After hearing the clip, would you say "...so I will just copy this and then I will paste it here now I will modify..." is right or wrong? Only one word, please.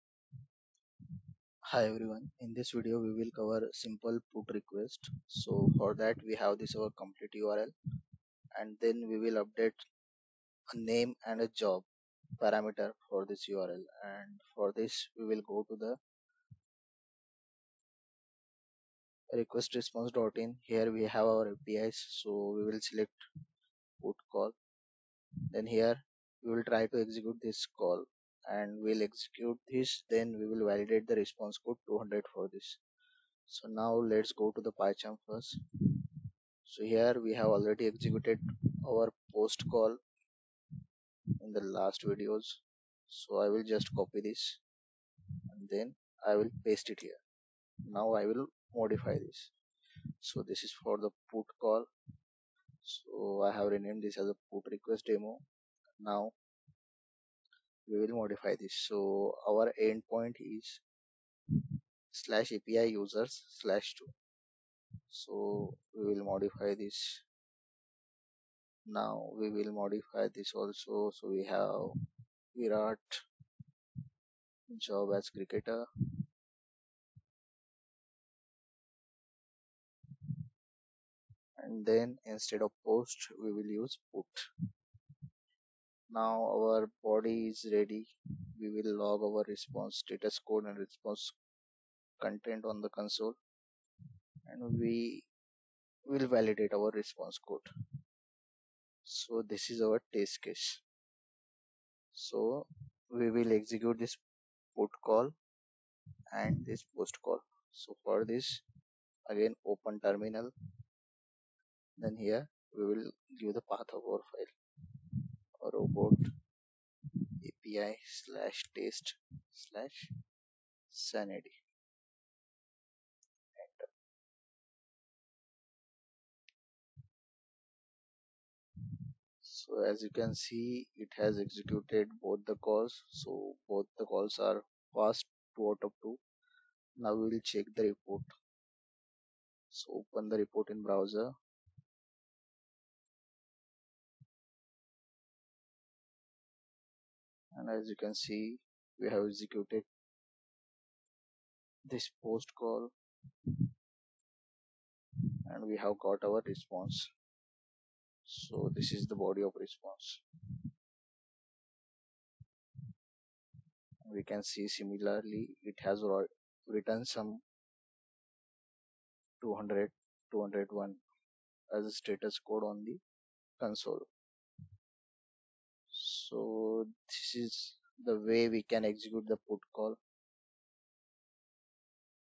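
right.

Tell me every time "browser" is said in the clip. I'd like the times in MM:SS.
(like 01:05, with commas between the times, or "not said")
02:20.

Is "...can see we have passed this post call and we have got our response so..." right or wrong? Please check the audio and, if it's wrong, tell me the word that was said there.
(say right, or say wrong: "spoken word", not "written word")
wrong: "executed", not "passed".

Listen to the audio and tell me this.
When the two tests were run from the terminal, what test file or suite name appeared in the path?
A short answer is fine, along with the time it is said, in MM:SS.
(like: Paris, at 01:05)
sanity, at 02:00.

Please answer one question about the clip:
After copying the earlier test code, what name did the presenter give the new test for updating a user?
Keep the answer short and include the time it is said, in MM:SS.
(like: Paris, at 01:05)
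put request demo, at 00:54.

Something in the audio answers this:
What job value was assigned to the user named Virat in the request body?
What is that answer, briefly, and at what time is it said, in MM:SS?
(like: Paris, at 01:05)
cricketer, at 01:15.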